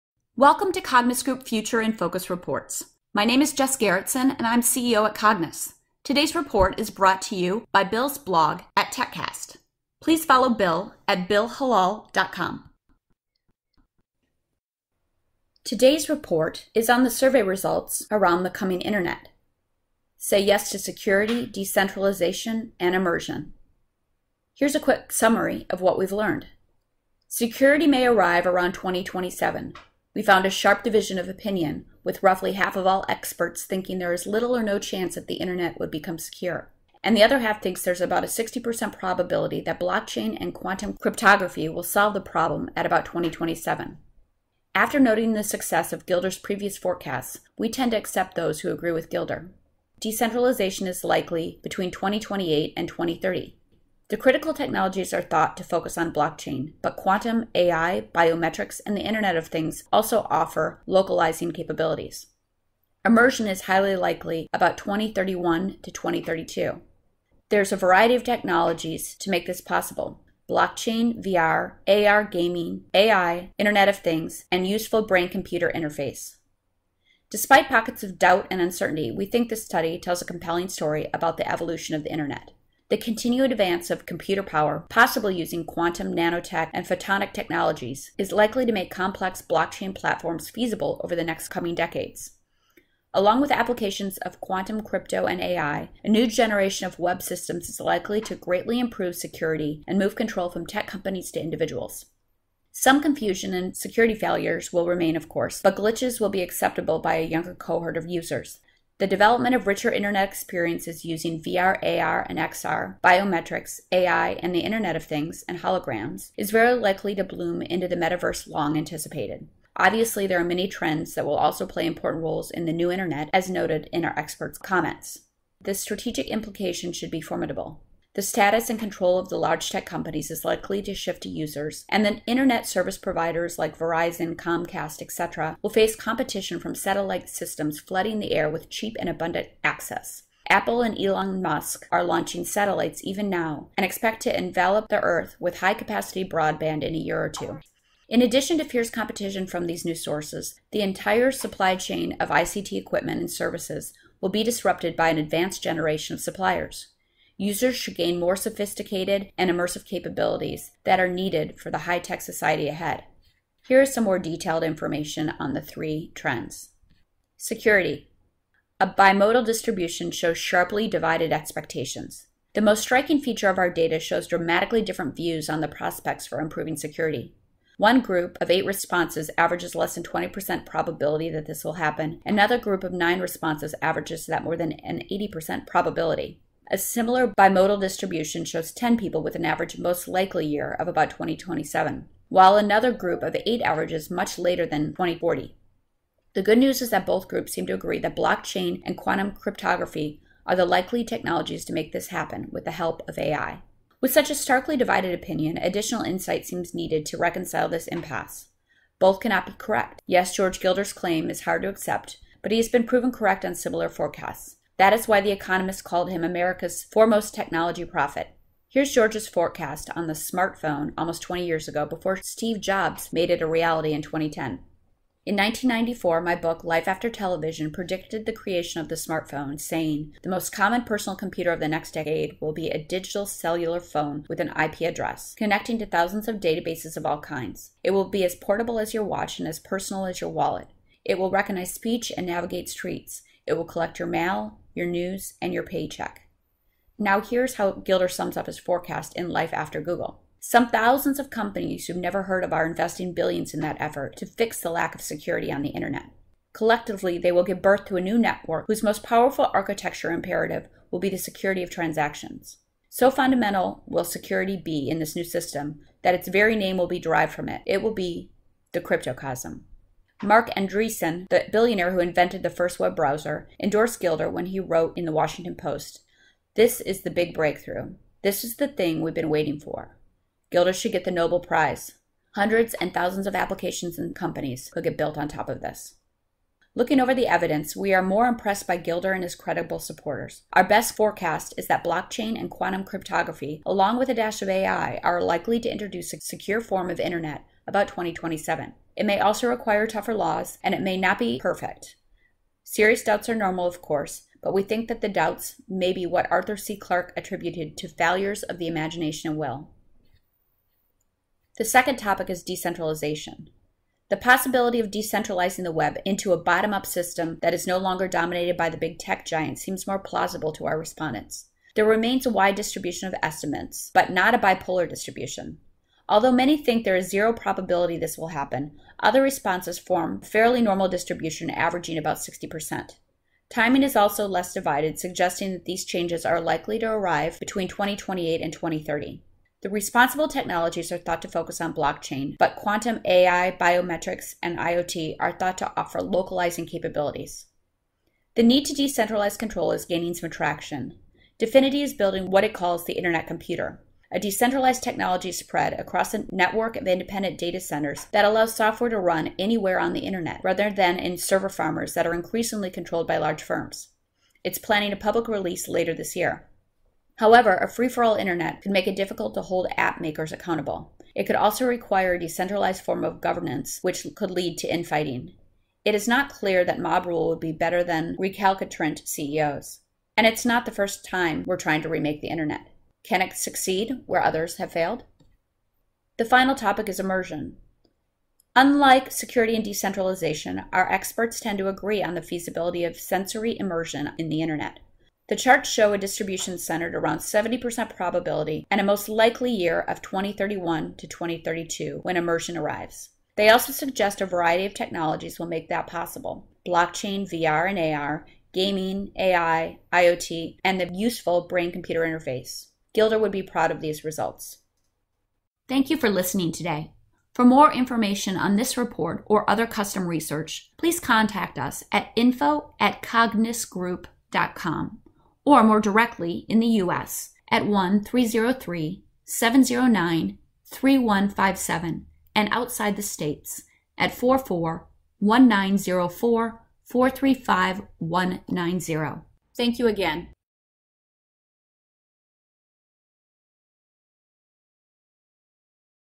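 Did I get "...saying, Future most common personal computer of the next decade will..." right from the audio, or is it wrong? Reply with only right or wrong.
wrong.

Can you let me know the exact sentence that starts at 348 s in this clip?
The need to decentralize control is gaining some traction.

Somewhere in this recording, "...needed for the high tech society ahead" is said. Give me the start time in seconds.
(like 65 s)
161 s.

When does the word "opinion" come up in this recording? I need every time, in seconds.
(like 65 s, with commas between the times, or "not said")
31 s, 205 s.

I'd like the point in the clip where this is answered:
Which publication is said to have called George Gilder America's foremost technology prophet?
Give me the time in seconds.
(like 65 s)
215 s.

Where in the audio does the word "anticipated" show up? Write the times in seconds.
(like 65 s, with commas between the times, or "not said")
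118 s.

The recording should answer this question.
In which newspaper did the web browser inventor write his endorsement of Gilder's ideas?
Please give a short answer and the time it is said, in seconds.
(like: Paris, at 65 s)
Washington Post, at 275 s.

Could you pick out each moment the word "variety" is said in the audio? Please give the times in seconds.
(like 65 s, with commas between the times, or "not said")
67 s, 404 s.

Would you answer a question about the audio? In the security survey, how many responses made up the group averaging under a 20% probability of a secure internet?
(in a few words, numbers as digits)
8.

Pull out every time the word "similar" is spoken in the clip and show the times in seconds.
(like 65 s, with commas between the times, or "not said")
186 s, 213 s.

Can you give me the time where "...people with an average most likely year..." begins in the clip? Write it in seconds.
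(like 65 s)
188 s.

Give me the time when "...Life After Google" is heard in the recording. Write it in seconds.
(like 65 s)
249 s.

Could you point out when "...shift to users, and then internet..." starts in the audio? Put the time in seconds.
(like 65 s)
130 s.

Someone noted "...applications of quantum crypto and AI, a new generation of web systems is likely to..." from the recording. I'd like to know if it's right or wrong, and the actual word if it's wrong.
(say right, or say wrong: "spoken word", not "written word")
right.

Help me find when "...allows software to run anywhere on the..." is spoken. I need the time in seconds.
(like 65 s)
358 s.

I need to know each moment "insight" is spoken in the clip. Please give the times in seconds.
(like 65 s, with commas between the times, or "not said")
206 s.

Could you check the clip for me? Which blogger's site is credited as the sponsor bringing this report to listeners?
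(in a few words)
TechCast.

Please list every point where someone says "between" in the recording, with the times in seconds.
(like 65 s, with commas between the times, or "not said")
51 s, 337 s.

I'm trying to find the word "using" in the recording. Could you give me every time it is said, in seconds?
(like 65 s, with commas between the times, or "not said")
85 s, 111 s.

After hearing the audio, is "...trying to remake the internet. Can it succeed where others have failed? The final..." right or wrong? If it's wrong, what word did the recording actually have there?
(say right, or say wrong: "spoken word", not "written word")
right.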